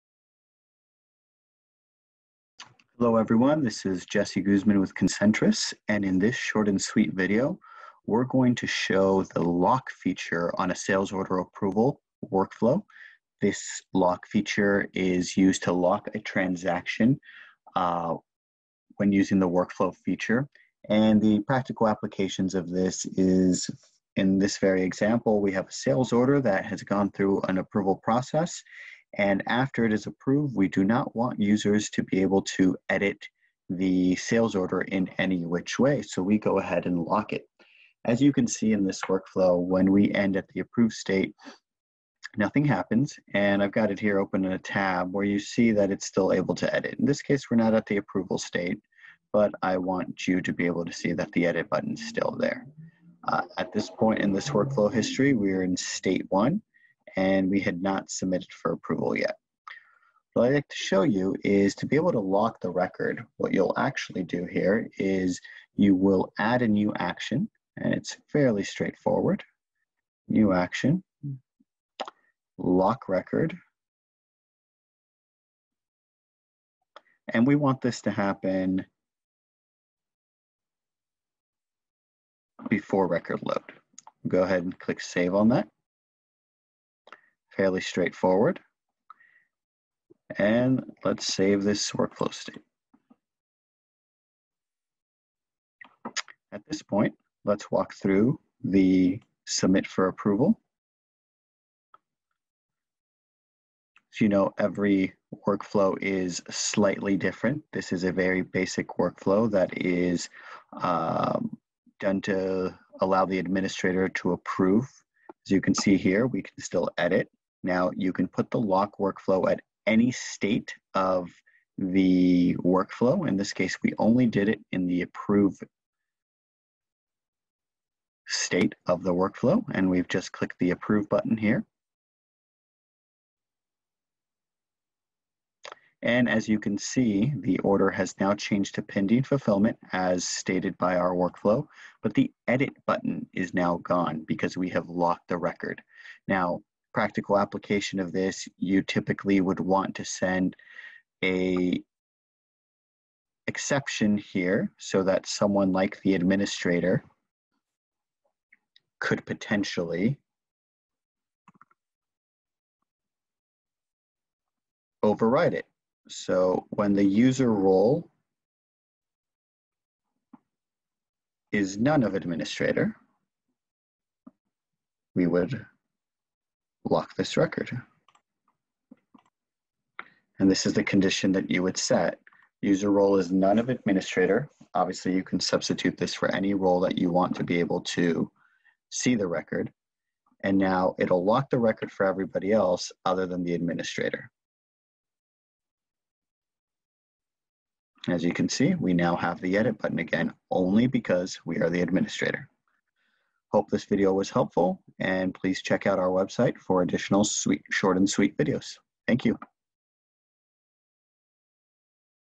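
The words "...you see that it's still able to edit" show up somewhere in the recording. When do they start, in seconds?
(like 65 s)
45 s.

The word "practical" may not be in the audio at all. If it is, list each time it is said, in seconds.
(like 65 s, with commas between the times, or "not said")
21 s, 146 s.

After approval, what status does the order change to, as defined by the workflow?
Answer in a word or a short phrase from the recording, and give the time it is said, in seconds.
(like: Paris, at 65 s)
Pending fulfillment, at 138 s.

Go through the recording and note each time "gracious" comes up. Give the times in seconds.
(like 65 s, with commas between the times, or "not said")
not said.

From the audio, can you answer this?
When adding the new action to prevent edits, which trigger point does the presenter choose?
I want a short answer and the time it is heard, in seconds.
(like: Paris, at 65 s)
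Before record load, at 82 s.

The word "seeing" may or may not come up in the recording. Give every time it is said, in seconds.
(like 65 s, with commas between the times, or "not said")
not said.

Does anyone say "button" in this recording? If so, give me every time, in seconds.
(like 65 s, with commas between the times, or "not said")
51 s, 131 s, 142 s, 199 s.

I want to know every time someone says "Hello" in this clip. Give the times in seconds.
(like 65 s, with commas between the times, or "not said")
2 s.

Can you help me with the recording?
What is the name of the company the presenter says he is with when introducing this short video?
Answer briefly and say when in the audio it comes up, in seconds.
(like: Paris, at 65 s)
Concentrus, at 4 s.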